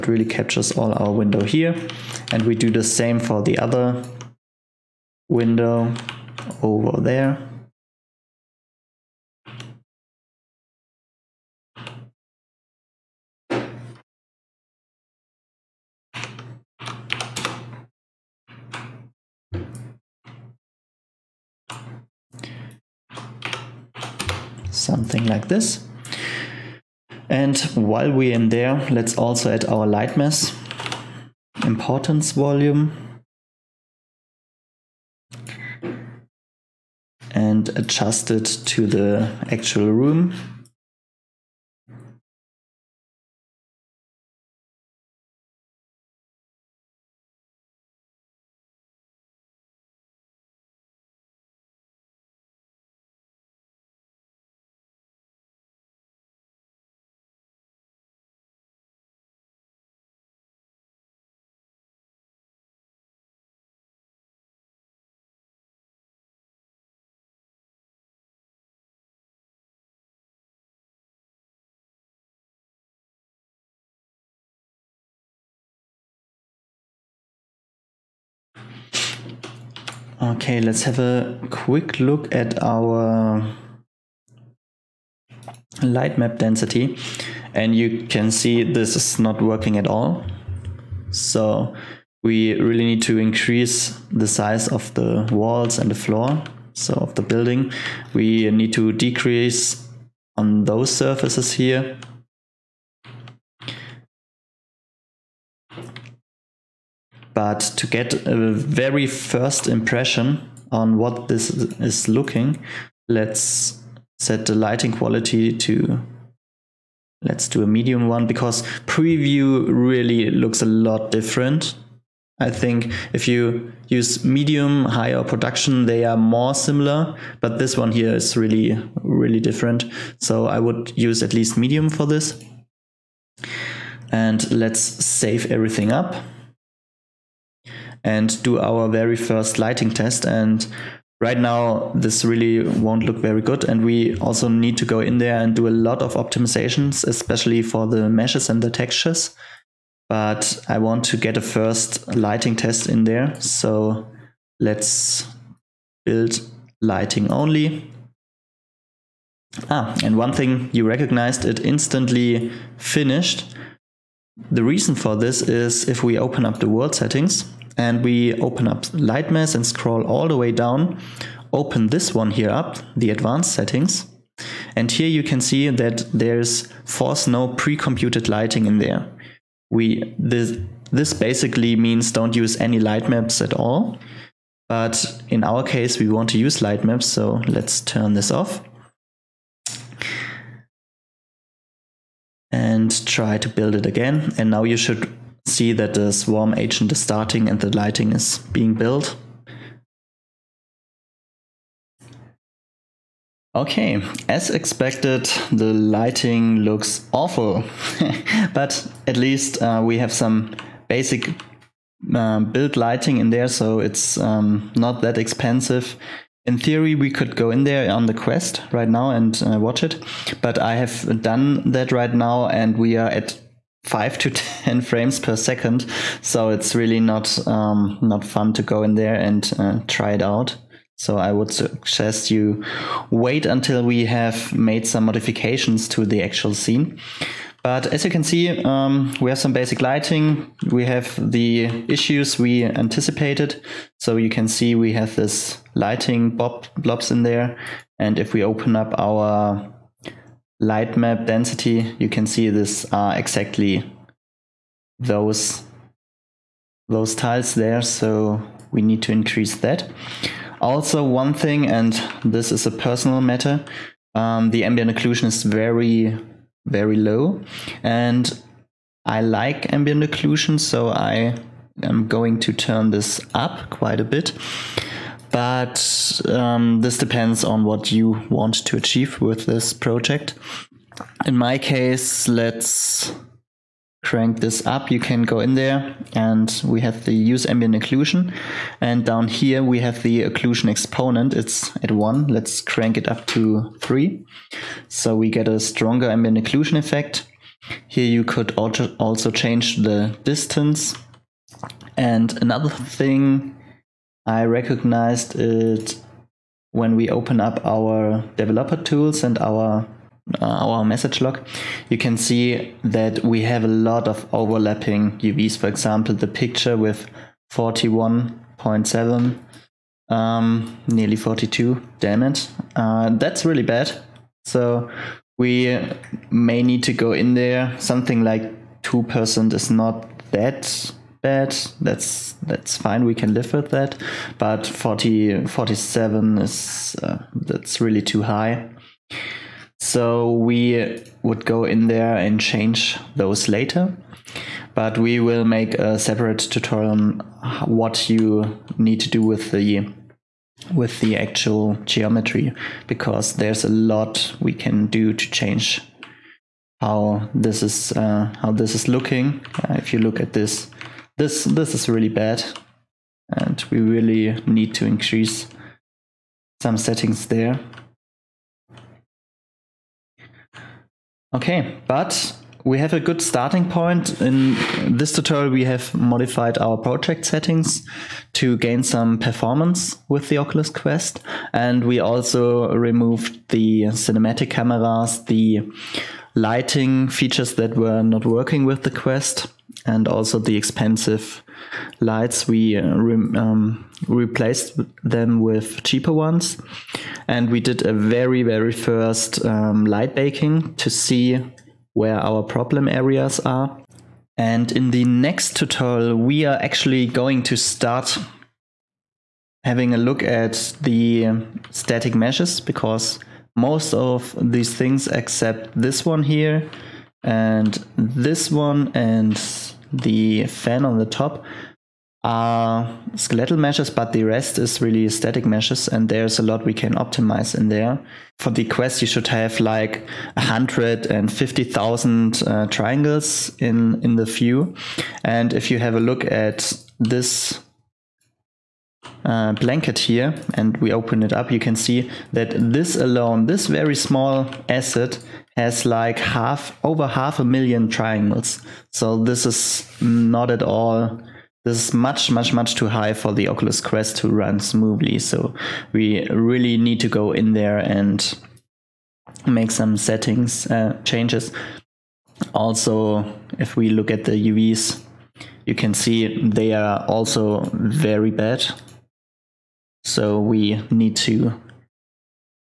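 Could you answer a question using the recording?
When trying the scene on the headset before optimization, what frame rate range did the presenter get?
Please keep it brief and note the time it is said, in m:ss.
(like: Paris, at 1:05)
5 to 10 frames per second, at 3:43.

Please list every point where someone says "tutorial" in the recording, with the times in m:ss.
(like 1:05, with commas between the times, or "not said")
5:46, 6:15, 6:45.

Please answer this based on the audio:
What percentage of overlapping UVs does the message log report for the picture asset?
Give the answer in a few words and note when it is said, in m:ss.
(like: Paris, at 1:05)
41.7%, at 5:17.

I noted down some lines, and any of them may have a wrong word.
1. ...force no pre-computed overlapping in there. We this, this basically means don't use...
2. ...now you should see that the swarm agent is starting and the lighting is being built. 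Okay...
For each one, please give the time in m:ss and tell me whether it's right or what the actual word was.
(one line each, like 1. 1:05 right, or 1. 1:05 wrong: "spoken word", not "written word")
1. 2:56 wrong: "lighting", not "overlapping"
2. 3:14 right.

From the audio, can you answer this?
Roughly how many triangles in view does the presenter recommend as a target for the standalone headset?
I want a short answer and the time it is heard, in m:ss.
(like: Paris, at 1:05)
150,000, at 7:10.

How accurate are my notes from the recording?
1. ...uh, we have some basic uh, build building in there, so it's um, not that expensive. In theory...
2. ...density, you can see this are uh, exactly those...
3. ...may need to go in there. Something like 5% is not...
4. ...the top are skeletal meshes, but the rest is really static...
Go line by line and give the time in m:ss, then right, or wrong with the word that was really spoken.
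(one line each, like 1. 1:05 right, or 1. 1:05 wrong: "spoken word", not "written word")
1. 3:29 wrong: "lighting", not "building"
2. 4:11 right
3. 5:26 wrong: "2", not "5"
4. 7:00 right.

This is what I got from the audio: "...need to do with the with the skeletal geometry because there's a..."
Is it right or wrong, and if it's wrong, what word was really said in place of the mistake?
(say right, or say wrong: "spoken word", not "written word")
wrong: "actual", not "skeletal".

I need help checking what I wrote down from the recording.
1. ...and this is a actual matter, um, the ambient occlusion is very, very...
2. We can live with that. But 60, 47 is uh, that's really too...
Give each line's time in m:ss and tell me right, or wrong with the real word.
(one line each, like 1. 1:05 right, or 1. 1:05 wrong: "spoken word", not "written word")
1. 4:21 wrong: "personal", not "actual"
2. 5:33 wrong: "40", not "60".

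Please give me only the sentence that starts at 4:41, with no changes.
In my case, let's crank this up.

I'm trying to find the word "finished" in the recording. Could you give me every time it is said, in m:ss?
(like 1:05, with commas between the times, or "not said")
2:42.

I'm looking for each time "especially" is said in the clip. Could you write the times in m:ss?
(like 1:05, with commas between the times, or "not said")
2:27.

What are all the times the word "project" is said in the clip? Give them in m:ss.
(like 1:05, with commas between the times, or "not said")
4:39, 6:16.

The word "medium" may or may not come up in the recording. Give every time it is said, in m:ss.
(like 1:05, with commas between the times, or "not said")
1:57, 2:04, 2:11.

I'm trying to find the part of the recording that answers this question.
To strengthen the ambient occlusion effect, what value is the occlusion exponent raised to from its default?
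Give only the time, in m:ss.
4:52.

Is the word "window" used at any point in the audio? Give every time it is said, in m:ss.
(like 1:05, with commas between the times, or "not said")
0:01, 0:05.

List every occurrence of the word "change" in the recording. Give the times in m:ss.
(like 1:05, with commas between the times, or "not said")
4:59, 5:42, 5:55, 7:41.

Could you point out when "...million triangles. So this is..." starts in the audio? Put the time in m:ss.
7:27.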